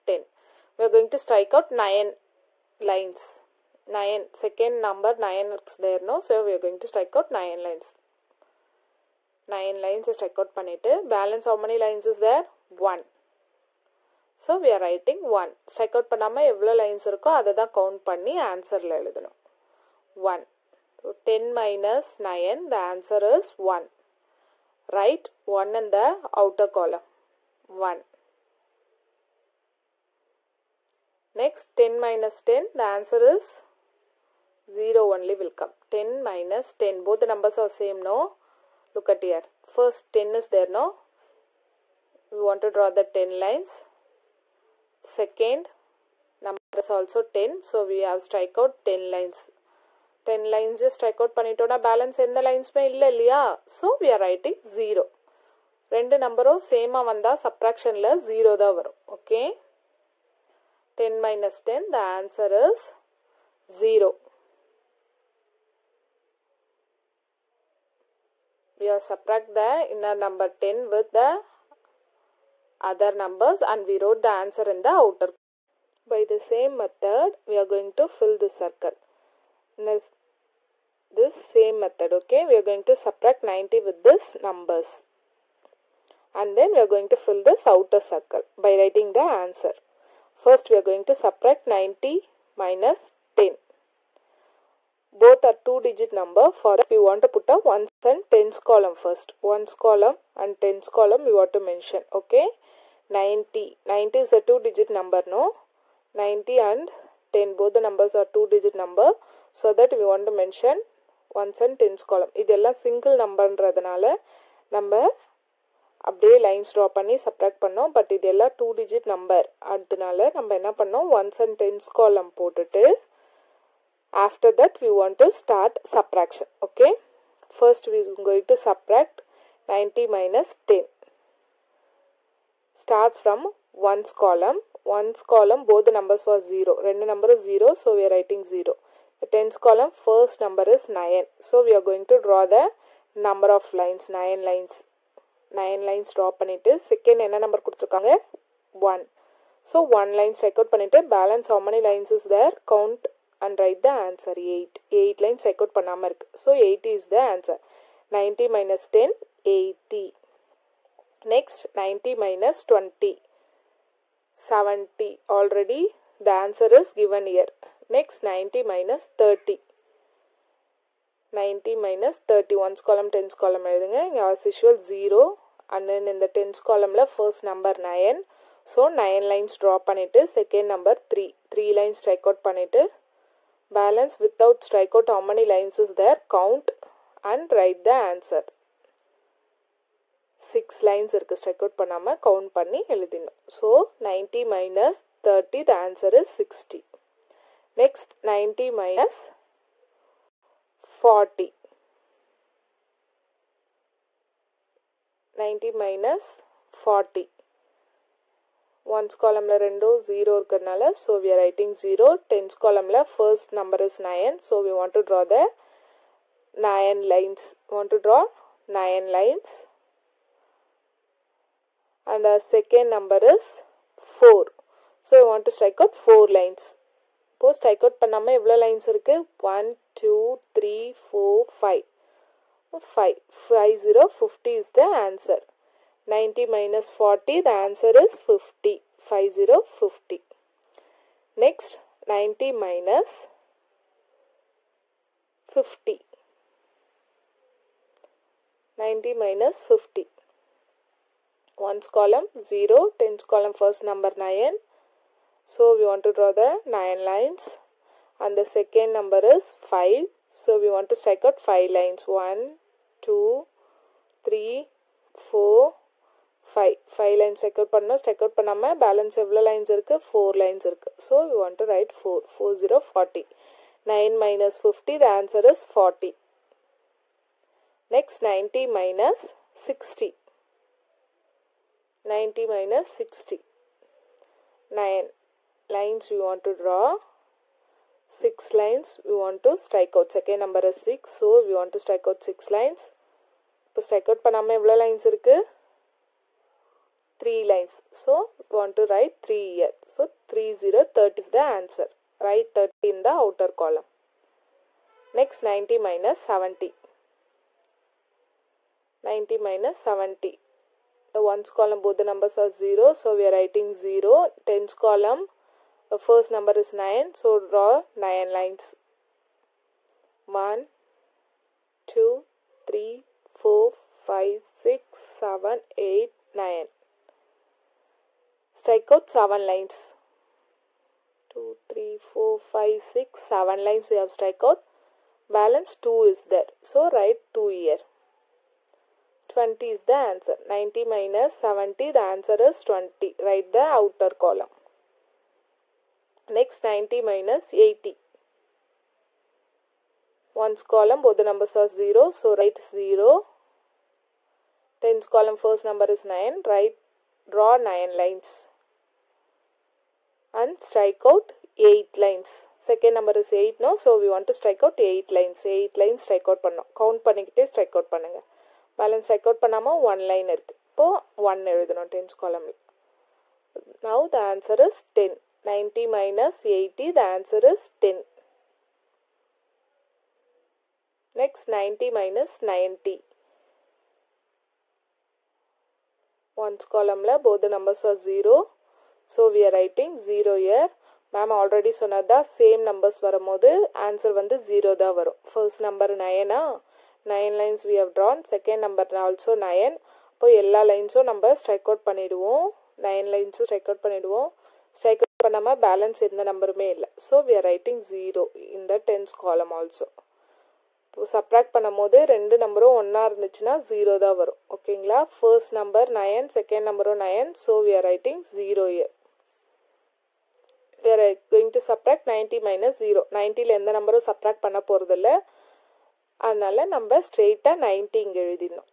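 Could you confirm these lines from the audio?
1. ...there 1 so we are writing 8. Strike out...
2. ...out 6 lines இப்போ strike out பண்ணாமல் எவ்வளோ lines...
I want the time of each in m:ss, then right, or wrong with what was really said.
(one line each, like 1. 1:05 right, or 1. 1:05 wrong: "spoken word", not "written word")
1. 0:12 wrong: "1", not "8"
2. 4:52 right.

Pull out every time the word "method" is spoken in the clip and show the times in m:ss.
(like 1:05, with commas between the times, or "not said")
1:16, 1:21.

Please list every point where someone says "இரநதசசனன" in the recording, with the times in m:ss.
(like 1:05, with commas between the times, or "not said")
6:53.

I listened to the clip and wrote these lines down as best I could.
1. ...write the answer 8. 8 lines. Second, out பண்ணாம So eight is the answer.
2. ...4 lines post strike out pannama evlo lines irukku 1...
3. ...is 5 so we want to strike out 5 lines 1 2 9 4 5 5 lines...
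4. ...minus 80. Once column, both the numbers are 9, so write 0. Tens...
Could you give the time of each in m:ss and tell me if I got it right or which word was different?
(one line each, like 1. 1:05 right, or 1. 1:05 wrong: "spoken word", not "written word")
1. 2:33 right
2. 3:46 right
3. 4:19 wrong: "3", not "9"
4. 5:47 wrong: "0", not "9".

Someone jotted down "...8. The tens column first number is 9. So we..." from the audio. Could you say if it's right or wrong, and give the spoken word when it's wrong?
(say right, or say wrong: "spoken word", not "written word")
wrong: "0", not "8".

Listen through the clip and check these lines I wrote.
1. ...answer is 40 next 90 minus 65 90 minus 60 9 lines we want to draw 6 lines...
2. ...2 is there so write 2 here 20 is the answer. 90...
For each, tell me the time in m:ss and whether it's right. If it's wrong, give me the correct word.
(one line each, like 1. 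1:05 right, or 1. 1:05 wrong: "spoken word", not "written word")
1. 4:35 wrong: "60", not "65"
2. 5:35 right.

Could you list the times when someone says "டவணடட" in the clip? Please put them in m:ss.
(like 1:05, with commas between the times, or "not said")
2:42.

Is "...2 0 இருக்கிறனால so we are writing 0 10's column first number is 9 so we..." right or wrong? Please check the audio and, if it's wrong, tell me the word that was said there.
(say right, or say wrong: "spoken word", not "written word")
right.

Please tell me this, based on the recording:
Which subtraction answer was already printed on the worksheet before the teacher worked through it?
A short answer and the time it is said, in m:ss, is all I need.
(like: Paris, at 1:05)
70, at 2:41.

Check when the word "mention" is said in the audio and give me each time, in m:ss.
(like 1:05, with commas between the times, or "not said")
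1:41, 1:50.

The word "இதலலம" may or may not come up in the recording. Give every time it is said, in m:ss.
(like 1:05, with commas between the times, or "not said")
1:52, 1:58.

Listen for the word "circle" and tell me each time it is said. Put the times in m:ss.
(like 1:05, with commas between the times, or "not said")
1:18, 1:28.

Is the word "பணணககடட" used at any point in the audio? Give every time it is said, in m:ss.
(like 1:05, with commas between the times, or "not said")
6:07.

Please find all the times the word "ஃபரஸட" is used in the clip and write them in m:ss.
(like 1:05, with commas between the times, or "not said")
2:07, 2:57, 6:35, 6:55.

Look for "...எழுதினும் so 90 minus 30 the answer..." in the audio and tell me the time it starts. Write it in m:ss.
3:12.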